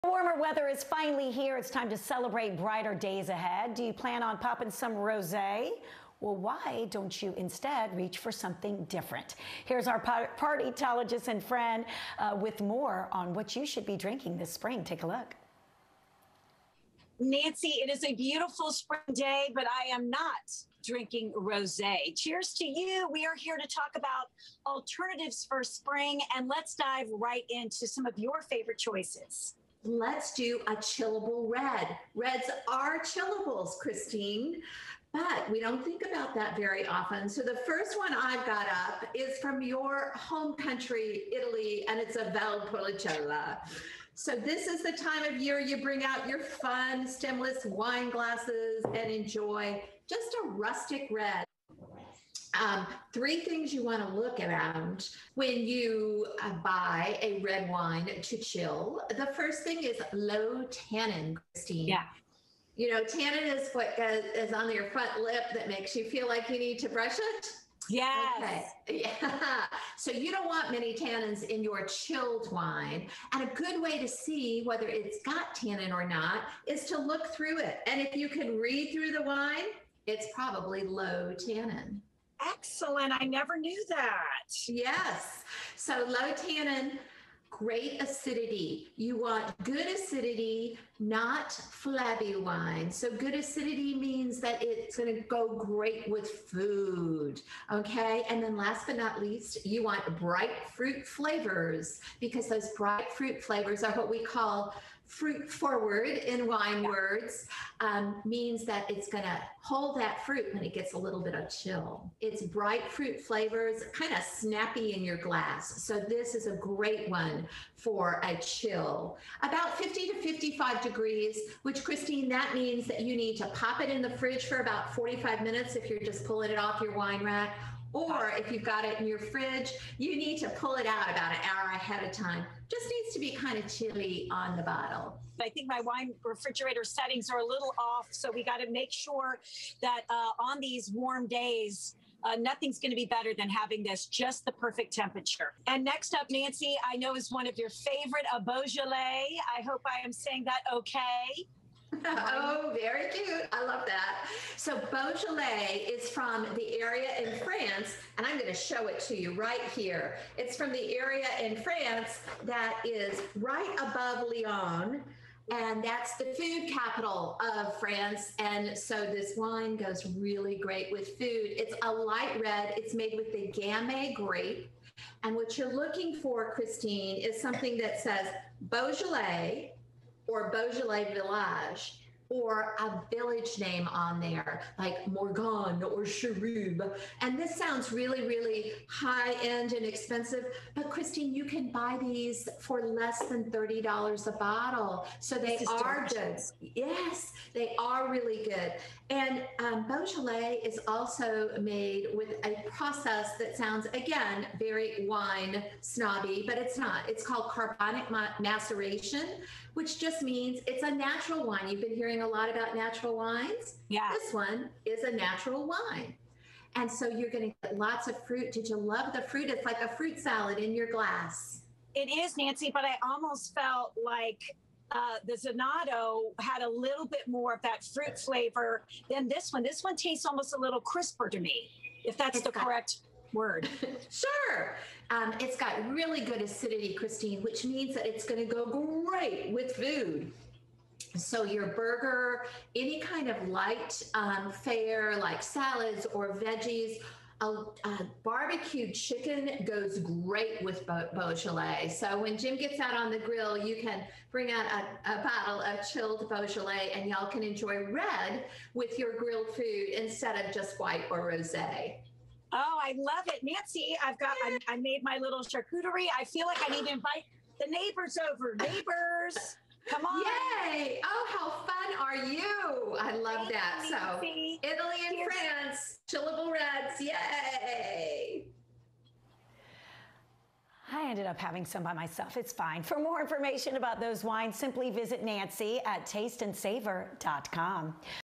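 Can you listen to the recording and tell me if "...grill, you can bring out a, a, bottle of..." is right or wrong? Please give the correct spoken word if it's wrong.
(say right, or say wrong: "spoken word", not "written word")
right.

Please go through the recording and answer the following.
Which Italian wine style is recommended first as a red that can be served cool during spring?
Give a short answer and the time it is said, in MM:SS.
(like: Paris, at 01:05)
Valpolicella, at 00:42.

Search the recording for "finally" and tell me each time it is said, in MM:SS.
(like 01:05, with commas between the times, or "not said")
00:00.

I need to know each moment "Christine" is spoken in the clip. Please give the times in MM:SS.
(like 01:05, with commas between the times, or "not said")
00:33, 01:01, 02:01, 02:56, 03:10, 03:56.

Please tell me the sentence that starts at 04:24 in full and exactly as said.
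I've got, I, I made my little charcuterie.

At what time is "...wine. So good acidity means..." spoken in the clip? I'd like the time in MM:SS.
01:32.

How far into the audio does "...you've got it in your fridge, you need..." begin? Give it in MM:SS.
02:08.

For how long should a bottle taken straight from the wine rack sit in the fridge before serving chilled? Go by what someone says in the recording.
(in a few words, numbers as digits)
45 minutes.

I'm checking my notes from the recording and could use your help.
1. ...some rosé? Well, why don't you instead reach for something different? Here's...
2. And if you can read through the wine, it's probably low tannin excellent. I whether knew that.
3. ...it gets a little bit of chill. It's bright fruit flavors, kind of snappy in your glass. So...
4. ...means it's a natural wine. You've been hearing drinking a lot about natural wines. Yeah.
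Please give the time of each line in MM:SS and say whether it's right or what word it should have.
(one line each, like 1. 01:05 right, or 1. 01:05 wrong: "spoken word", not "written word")
1. 00:04 right
2. 01:17 wrong: "never", not "whether"
3. 01:50 right
4. 03:30 wrong: "hearing", not "drinking".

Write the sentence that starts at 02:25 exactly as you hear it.
And next up, Nancy, I know is one of your favorite, a Beaujolais.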